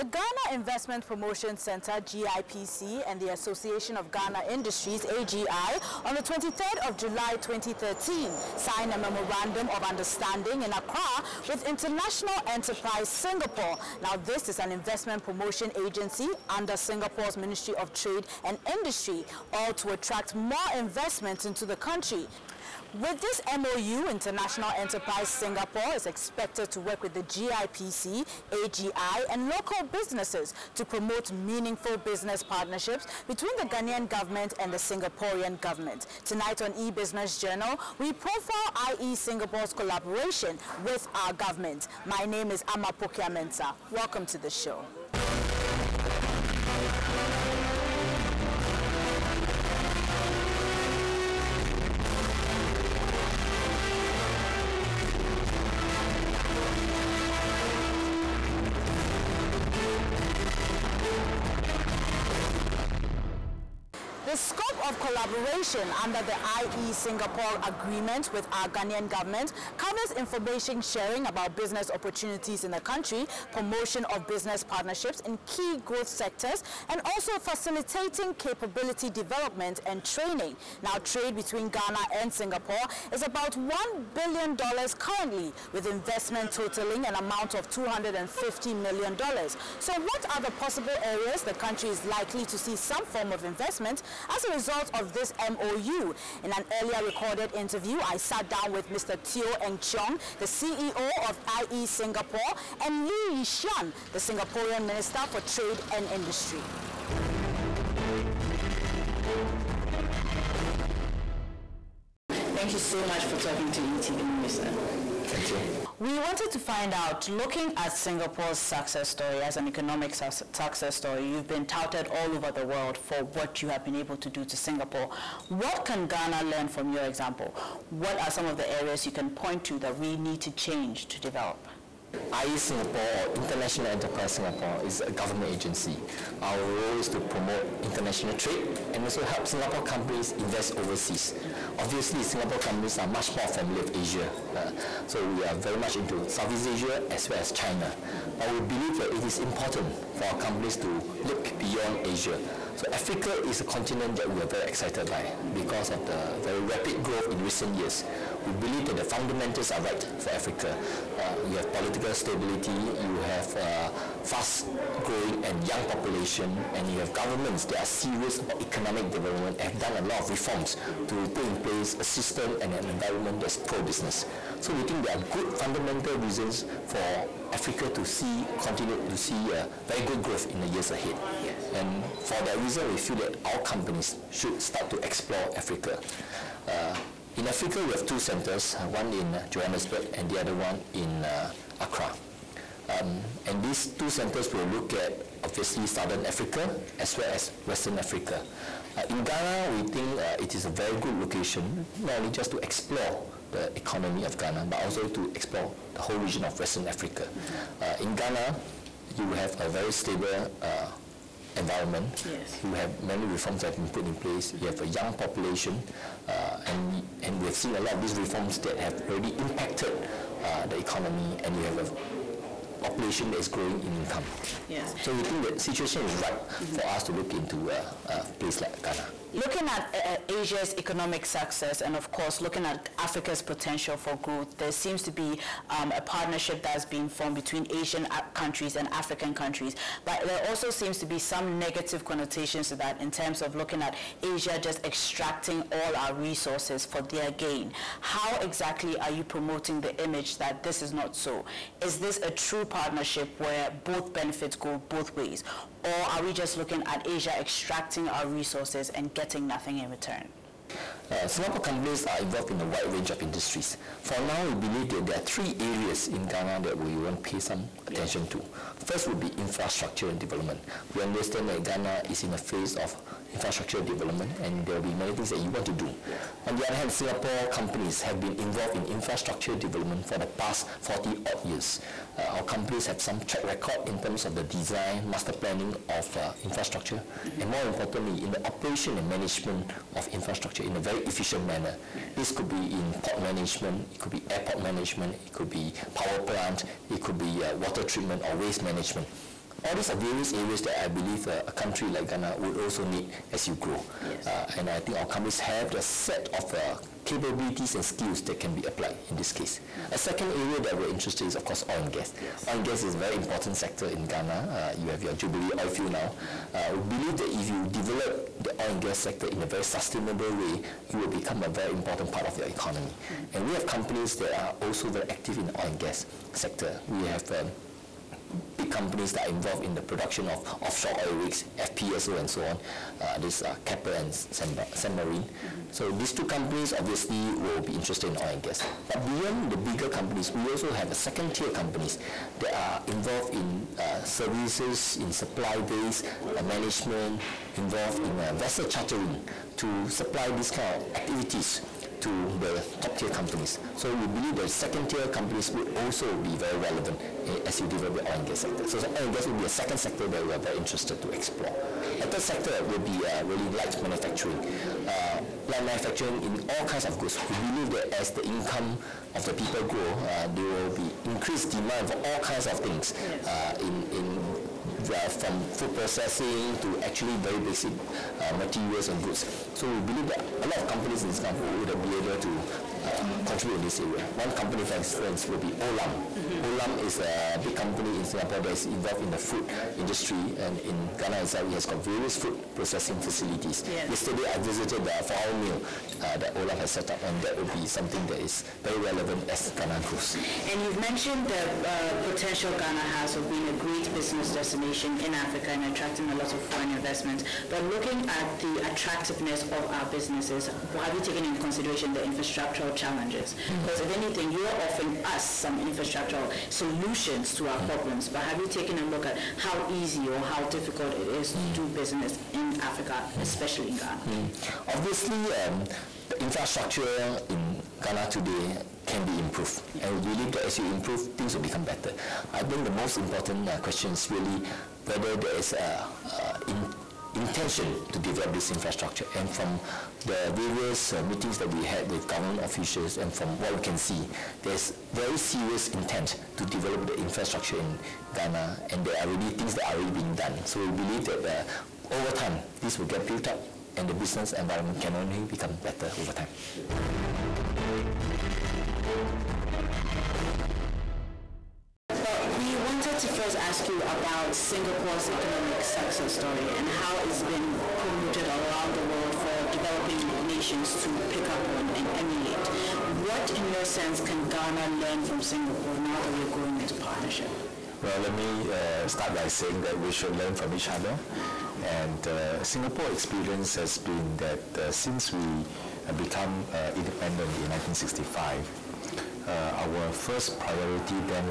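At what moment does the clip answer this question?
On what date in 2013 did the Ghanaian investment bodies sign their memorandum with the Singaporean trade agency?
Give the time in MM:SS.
00:06.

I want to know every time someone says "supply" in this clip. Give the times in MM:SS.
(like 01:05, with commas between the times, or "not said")
05:45, 05:49.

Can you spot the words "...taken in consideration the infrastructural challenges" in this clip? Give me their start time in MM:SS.
06:51.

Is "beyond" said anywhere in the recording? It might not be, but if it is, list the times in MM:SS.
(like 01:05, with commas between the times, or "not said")
02:31, 05:39.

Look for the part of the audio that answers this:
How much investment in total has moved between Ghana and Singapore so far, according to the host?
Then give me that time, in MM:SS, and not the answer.
01:27.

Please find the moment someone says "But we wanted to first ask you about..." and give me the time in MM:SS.
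07:42.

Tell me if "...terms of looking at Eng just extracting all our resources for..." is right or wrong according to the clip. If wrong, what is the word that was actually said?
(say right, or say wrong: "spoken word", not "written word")
wrong: "Asia", not "Eng".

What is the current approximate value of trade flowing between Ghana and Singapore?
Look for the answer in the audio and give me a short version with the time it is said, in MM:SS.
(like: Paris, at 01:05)
$1 billion, at 01:23.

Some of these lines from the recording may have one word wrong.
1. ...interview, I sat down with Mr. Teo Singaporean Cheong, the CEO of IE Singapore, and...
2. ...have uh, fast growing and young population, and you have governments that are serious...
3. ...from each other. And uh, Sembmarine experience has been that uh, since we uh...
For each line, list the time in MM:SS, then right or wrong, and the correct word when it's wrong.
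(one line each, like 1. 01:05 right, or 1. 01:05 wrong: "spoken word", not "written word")
1. 01:37 wrong: "Eng", not "Singaporean"
2. 02:43 right
3. 08:00 wrong: "Singapore", not "Sembmarine".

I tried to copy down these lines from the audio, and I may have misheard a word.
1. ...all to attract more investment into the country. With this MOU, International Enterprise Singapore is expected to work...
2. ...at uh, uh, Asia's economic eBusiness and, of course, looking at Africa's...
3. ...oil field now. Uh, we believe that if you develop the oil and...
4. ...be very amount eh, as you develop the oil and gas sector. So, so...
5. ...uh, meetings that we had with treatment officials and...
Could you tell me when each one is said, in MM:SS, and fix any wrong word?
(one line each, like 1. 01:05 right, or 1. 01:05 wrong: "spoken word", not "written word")
1. 00:19 right
2. 03:49 wrong: "success", not "eBusiness"
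3. 05:15 right
4. 05:56 wrong: "relevant", not "amount"
5. 07:20 wrong: "government", not "treatment".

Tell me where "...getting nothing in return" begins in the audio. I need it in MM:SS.
04:19.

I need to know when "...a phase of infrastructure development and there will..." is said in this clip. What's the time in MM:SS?
04:32.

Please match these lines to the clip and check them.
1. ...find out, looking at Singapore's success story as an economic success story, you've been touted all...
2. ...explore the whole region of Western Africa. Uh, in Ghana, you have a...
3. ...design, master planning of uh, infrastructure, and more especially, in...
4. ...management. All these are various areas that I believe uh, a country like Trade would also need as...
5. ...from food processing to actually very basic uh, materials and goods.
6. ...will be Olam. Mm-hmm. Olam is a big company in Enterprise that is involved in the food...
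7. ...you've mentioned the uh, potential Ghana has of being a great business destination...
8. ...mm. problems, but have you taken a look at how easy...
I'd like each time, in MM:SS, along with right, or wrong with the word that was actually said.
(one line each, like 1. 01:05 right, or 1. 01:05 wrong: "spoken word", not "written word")
1. 01:56 right
2. 03:25 right
3. 04:44 wrong: "importantly", not "especially"
4. 04:58 wrong: "Ghana", not "Trade"
5. 06:15 right
6. 06:25 wrong: "Singapore", not "Enterprise"
7. 06:40 right
8. 06:57 right.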